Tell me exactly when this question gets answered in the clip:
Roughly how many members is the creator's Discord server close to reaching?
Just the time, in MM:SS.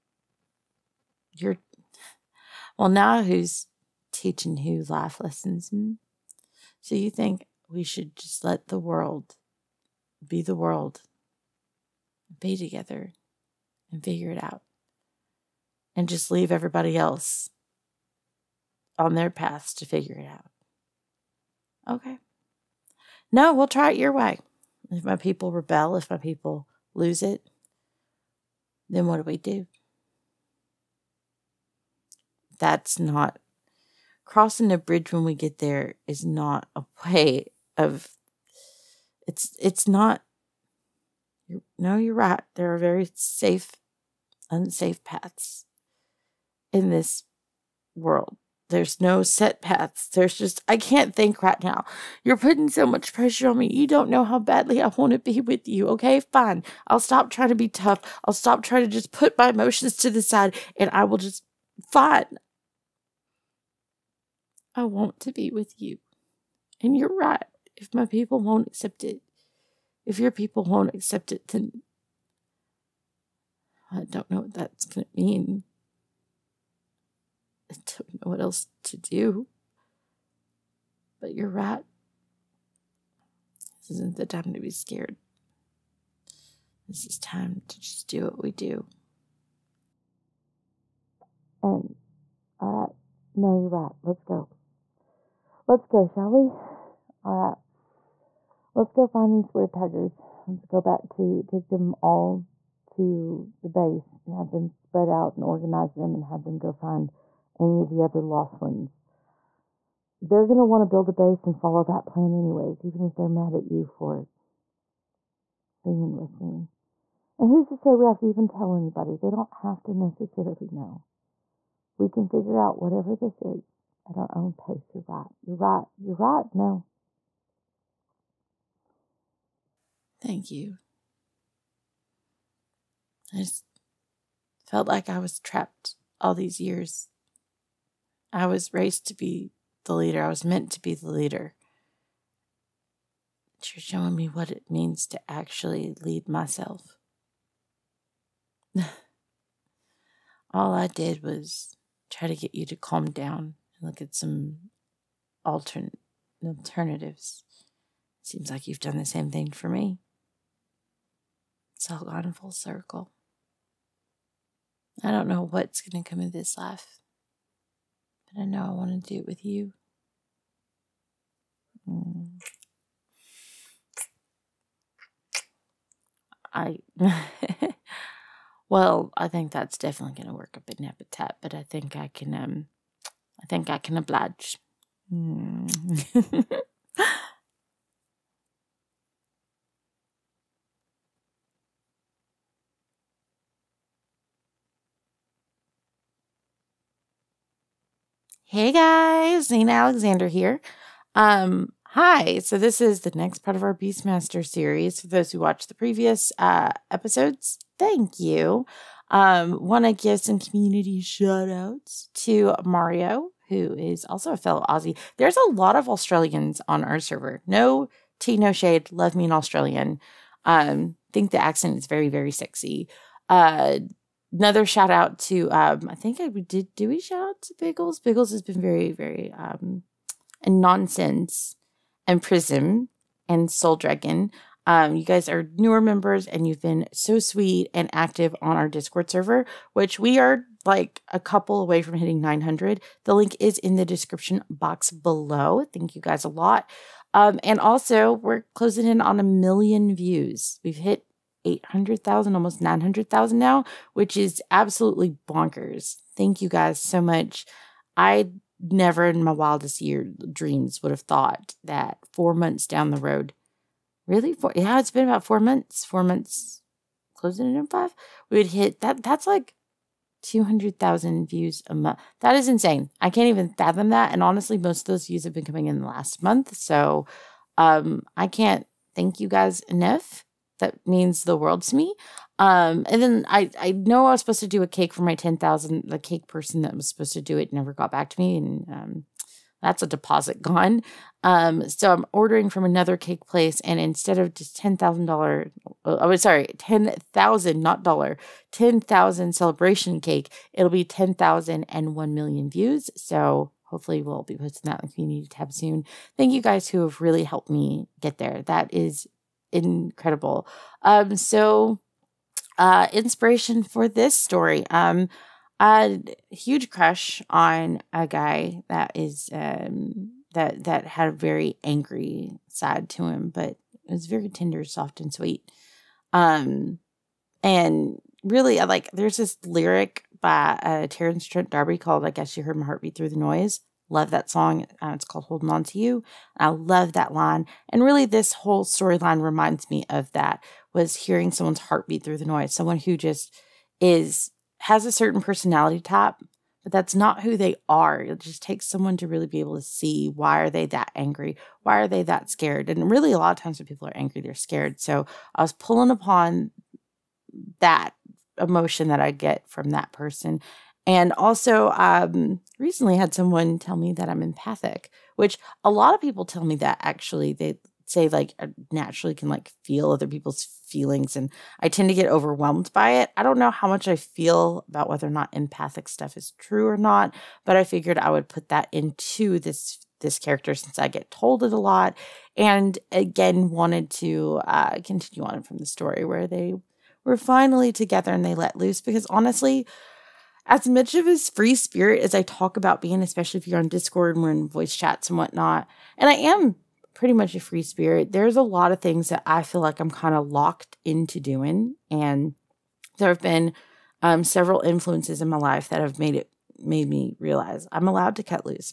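04:02.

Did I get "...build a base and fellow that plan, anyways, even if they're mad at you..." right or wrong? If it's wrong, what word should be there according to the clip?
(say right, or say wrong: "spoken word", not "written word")
wrong: "follow", not "fellow".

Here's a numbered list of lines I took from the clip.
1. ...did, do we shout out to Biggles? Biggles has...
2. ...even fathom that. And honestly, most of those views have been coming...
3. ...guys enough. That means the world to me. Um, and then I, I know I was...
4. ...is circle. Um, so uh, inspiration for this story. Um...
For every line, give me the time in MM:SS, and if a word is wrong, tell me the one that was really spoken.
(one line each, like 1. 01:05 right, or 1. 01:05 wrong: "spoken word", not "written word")
1. 03:46 right
2. 04:33 right
3. 04:39 right
4. 05:08 wrong: "incredible", not "circle".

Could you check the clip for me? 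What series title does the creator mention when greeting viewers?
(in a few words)
Beastmaster.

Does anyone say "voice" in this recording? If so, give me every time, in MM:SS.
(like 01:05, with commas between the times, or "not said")
06:34.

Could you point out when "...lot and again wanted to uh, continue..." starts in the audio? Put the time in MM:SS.
06:21.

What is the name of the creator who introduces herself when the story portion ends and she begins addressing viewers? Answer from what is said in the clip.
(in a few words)
Zena Alexander.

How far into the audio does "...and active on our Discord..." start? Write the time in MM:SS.
03:57.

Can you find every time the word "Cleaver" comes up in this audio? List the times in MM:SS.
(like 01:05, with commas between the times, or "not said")
not said.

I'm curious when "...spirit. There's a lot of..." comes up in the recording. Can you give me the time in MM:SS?
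06:37.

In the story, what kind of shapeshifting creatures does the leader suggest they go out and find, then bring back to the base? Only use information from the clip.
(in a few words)
Weretigers.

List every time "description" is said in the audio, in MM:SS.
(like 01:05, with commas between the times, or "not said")
04:03.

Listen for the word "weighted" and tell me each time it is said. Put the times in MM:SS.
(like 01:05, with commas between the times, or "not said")
not said.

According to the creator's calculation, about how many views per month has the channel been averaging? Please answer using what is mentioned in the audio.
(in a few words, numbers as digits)
200,000.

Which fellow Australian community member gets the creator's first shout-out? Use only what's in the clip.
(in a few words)
Mario.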